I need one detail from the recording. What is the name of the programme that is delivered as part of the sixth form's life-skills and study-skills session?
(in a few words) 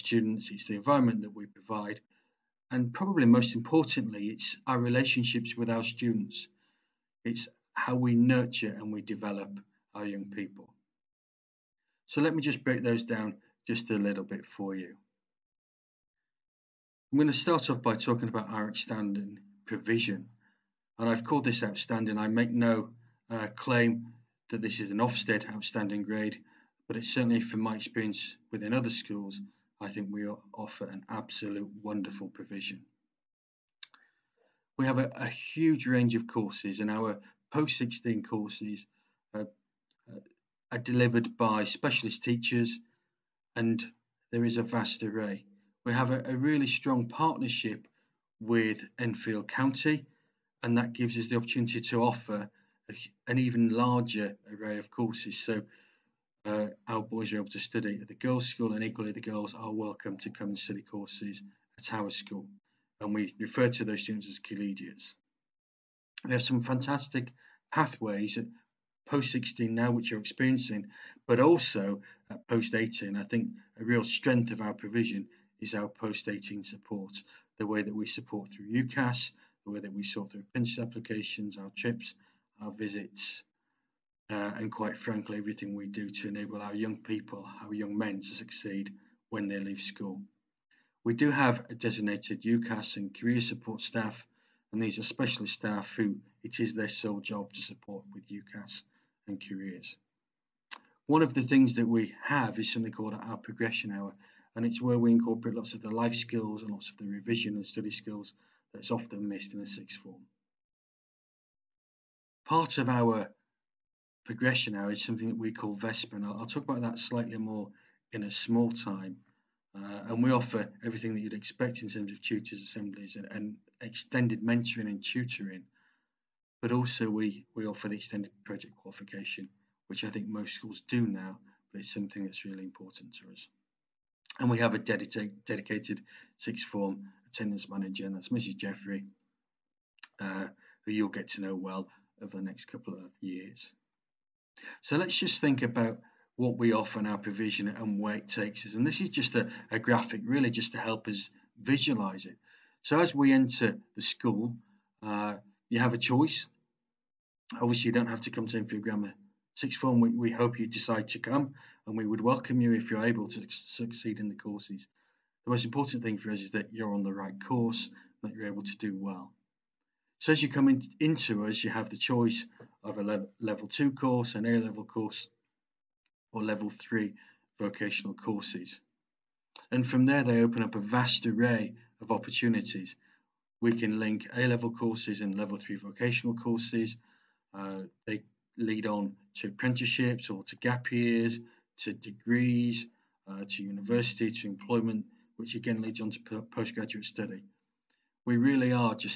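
VESPA.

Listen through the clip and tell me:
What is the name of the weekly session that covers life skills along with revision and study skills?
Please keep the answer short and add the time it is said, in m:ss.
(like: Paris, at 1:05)
Progression hour, at 1:43.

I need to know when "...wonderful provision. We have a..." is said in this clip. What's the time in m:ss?
0:31.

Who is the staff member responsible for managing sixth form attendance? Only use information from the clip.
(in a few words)
Mrs. Jeffrey.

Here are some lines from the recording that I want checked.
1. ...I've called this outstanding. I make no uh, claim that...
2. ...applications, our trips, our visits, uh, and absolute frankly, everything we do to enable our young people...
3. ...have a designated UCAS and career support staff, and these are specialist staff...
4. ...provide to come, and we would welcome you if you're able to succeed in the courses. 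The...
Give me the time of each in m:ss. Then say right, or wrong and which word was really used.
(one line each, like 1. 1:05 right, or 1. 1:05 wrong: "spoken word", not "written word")
1. 0:21 right
2. 1:20 wrong: "quite", not "absolute"
3. 1:31 right
4. 2:40 wrong: "decide", not "provide".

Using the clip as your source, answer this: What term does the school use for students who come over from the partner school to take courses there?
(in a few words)
Collegiates.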